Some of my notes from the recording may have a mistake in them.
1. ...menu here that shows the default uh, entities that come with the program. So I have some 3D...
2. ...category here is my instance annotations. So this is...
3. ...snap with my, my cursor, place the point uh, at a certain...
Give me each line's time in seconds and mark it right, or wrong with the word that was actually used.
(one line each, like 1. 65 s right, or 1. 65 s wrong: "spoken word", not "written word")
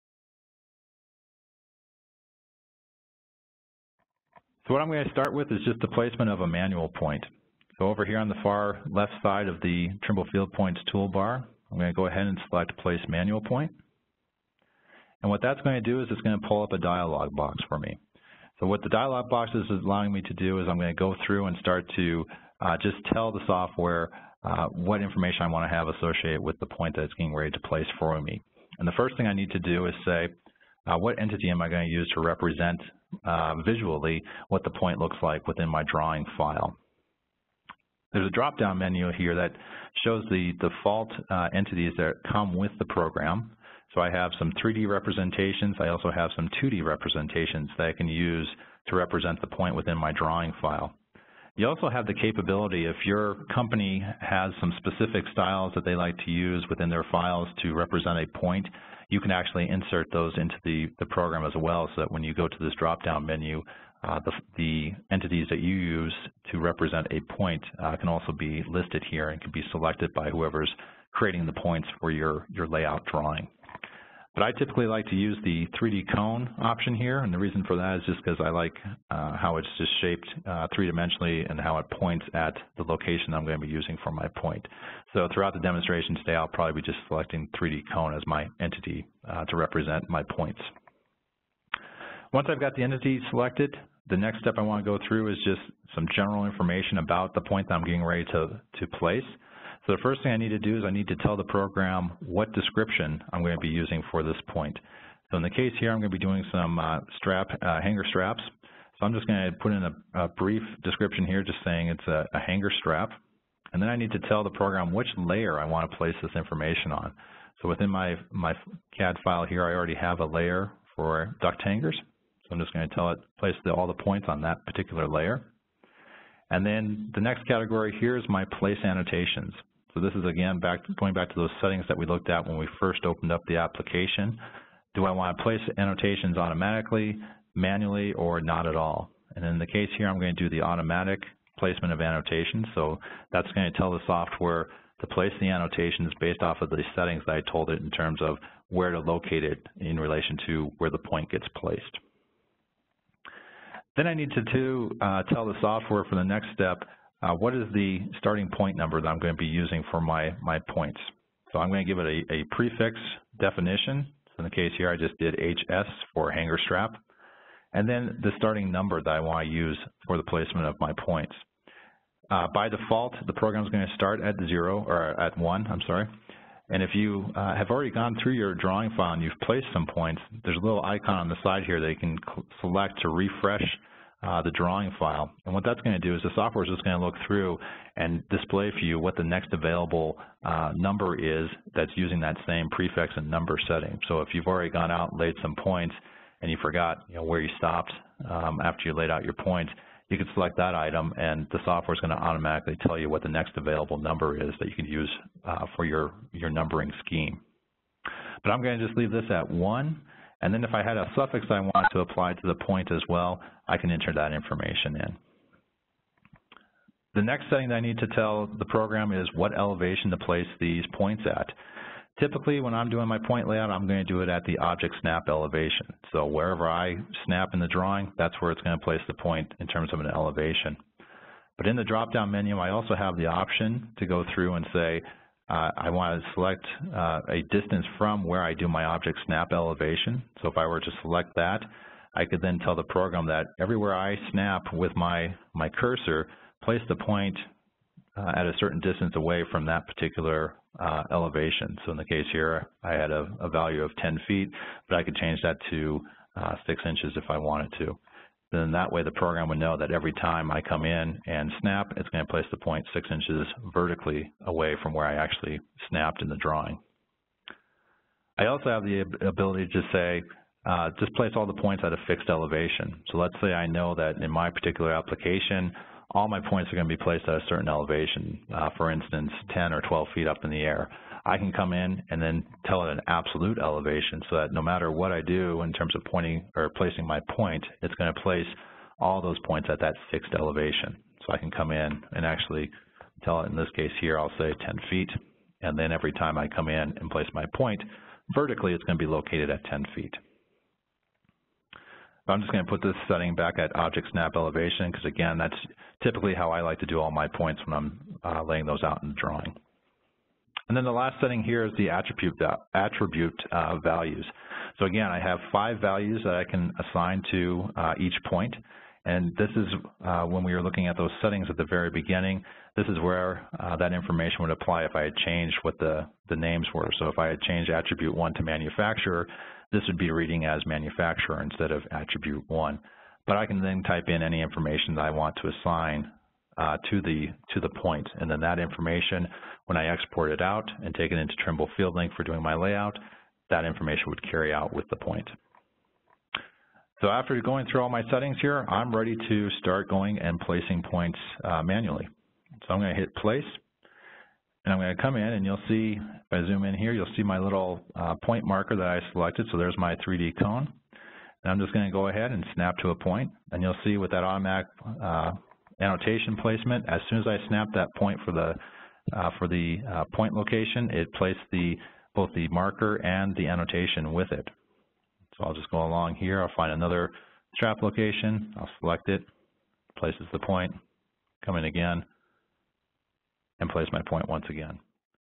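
1. 38 s right
2. 127 s wrong: "place", not "instance"
3. 244 s right.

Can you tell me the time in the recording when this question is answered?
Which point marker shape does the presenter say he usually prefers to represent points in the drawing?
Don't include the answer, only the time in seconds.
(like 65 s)
75 s.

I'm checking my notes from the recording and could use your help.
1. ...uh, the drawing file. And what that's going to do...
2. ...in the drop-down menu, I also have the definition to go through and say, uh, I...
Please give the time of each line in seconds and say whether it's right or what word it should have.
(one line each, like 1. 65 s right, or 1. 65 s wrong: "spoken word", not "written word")
1. 184 s right
2. 231 s wrong: "option", not "definition".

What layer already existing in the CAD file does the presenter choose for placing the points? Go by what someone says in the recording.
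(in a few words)
duct hangers.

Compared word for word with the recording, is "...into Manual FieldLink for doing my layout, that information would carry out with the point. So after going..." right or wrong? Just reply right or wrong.
wrong.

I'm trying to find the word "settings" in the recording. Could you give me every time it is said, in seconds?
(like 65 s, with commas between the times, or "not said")
131 s, 146 s, 193 s, 217 s, 303 s, 311 s, 321 s, 348 s.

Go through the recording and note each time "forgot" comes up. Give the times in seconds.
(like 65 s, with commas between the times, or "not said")
196 s.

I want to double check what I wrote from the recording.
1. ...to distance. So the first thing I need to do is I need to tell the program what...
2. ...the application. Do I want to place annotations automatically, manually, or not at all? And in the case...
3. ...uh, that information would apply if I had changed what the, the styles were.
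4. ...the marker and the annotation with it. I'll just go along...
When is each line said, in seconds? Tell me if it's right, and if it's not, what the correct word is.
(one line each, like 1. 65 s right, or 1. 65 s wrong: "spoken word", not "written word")
1. 98 s wrong: "place", not "distance"
2. 133 s right
3. 323 s wrong: "names", not "styles"
4. 372 s right.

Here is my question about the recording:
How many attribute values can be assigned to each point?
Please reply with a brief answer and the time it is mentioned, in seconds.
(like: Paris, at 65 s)
5, at 315 s.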